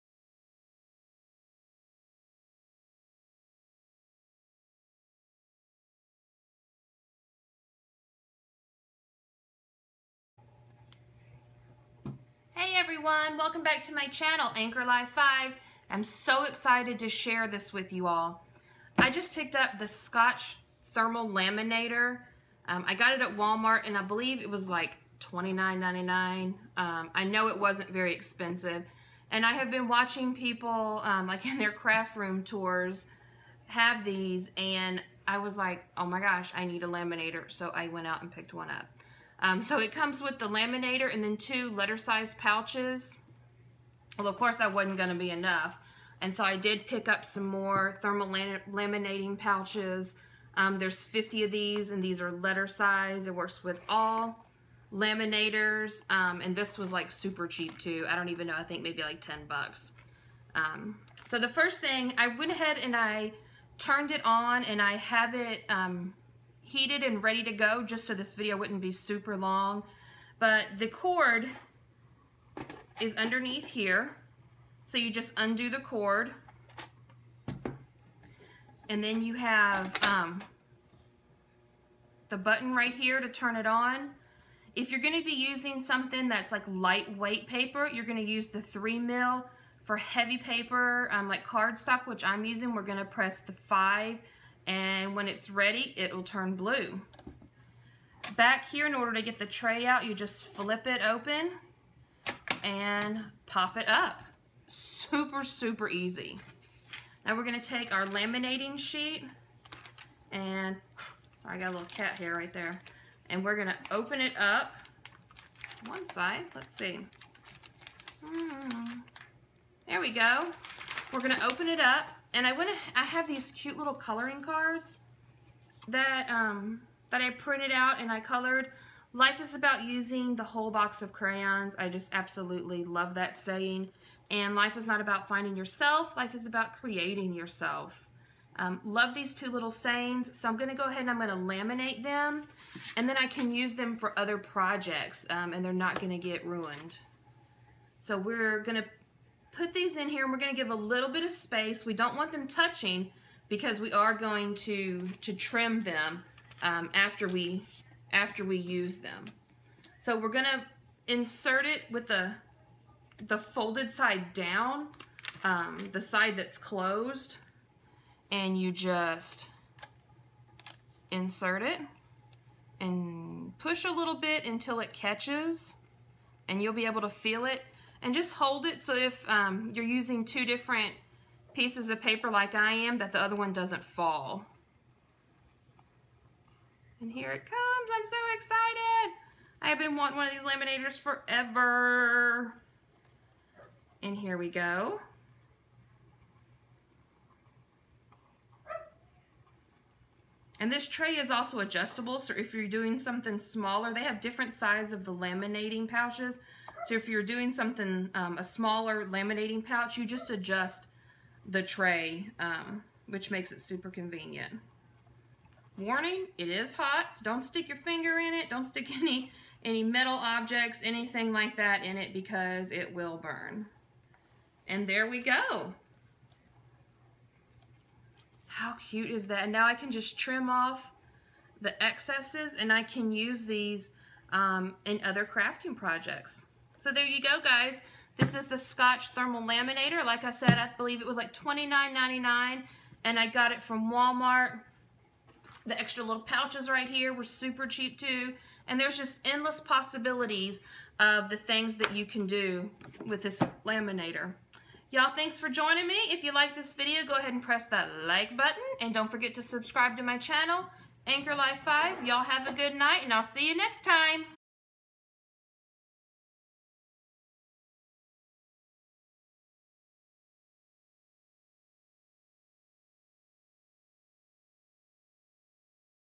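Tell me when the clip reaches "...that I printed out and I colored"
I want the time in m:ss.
2:07.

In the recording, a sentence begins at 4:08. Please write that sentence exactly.
And there's just endless possibilities of the things that you can do with this laminator.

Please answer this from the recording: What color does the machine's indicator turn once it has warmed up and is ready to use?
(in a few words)
Blue.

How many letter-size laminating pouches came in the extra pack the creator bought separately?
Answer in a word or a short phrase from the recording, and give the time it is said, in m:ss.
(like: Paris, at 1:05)
50, at 0:50.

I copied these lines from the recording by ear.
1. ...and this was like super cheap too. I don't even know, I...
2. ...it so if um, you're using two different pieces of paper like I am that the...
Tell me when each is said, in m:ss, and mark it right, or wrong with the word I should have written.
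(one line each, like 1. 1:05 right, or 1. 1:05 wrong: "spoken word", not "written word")
1. 0:56 right
2. 2:58 right.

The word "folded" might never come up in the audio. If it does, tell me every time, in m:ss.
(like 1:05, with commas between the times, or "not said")
2:43.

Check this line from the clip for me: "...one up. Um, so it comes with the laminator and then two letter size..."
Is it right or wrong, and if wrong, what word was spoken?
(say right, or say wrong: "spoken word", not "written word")
right.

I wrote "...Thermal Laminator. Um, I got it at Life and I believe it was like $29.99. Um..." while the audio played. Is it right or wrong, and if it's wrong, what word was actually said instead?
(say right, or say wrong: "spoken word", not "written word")
wrong: "Walmart", not "Life".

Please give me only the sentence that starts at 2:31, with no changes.
We don't want them touching because we are going to, to trim them um, after, we, after we use them.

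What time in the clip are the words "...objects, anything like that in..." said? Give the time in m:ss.
3:40.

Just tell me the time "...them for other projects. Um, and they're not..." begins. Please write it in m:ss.
2:23.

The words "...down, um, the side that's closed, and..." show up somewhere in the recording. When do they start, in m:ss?
2:44.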